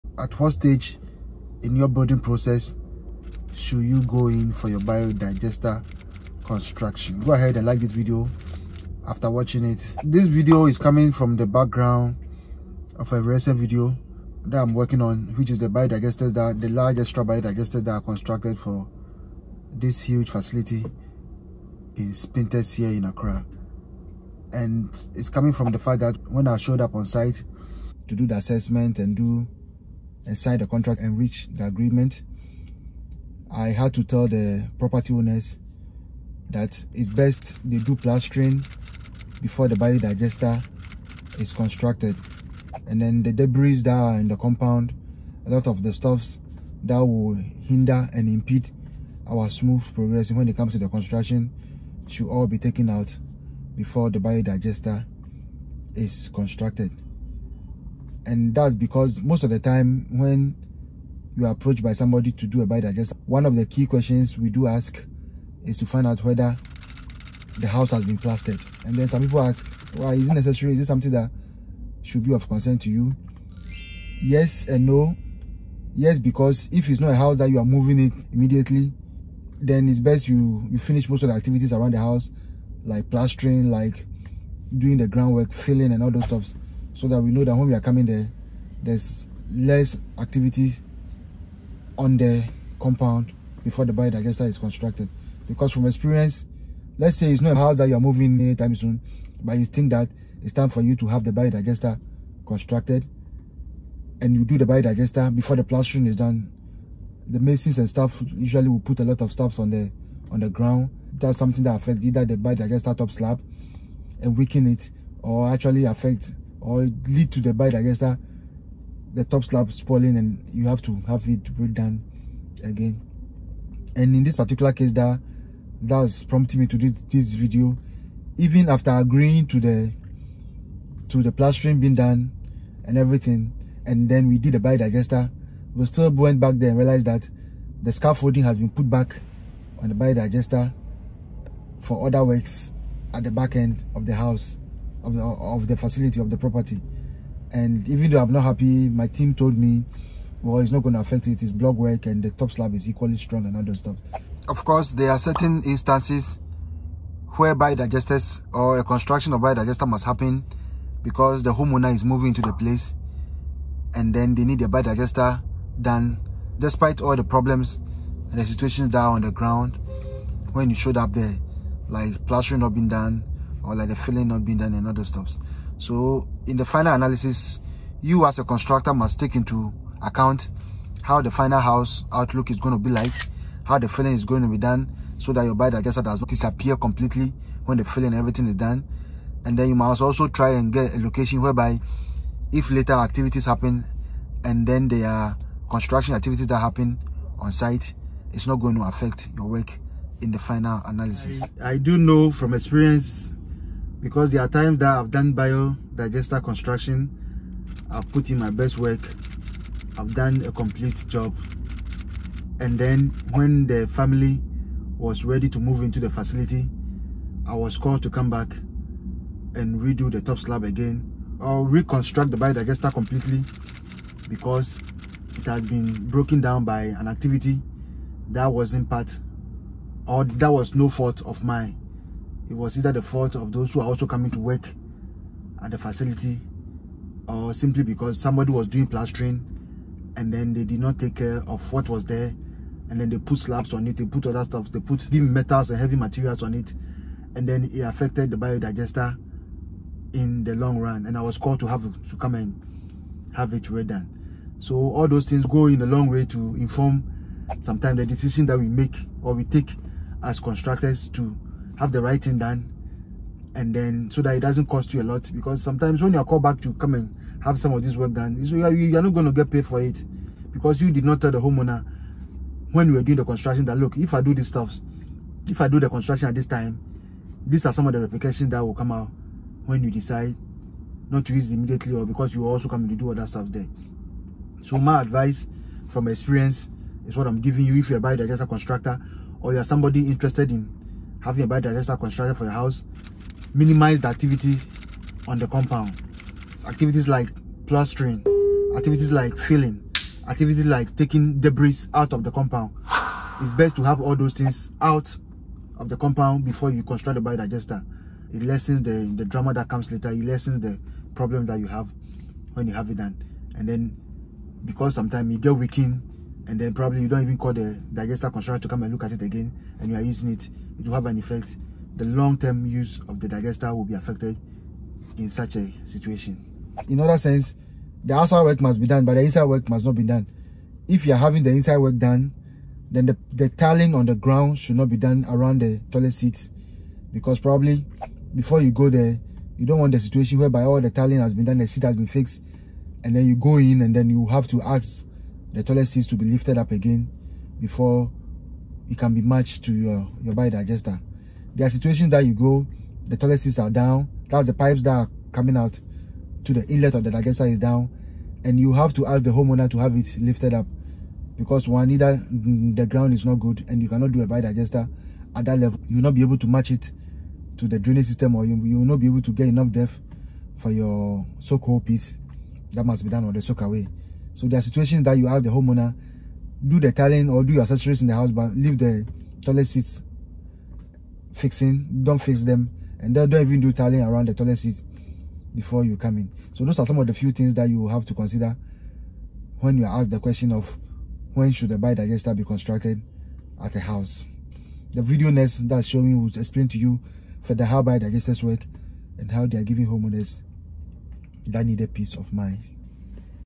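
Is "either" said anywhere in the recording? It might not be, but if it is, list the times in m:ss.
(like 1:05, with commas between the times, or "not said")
1:52, 3:52, 6:01.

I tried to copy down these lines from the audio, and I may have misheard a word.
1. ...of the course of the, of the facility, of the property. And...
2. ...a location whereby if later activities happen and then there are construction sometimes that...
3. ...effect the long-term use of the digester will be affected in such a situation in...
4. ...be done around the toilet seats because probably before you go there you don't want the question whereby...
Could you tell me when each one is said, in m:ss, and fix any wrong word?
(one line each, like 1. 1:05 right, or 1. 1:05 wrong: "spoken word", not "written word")
1. 2:23 wrong: "house", not "course"
2. 3:10 wrong: "activities", not "sometimes"
3. 5:21 right
4. 5:34 wrong: "situation", not "question".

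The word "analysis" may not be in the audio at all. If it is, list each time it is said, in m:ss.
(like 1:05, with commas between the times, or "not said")
2:56, 3:20.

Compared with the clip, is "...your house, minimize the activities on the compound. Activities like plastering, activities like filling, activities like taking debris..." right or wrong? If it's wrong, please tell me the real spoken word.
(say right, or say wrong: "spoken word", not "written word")
right.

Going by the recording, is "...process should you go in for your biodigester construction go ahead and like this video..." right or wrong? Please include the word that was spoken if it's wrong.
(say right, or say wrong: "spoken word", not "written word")
right.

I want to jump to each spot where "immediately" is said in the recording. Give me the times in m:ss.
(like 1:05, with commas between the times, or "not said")
1:18, 4:41.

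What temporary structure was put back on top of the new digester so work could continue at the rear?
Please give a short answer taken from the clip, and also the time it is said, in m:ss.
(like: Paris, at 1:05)
Scaffolding, at 2:17.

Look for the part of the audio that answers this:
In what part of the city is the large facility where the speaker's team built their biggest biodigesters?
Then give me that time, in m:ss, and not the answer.
0:22.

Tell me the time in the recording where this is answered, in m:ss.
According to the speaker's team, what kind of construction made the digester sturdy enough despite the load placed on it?
2:31.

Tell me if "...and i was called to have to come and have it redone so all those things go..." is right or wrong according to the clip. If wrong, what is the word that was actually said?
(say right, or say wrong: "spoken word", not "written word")
right.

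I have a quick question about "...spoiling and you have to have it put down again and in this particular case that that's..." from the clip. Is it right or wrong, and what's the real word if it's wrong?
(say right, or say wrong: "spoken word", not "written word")
right.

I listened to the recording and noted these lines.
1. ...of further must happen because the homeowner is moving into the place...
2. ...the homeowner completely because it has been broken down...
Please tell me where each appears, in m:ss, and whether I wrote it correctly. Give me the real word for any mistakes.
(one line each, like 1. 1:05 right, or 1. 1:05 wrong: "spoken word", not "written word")
1. 2:39 wrong: "biodigester", not "further"
2. 3:42 wrong: "biodigester", not "homeowner".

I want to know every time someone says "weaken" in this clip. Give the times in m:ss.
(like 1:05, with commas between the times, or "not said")
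1:54, 5:15.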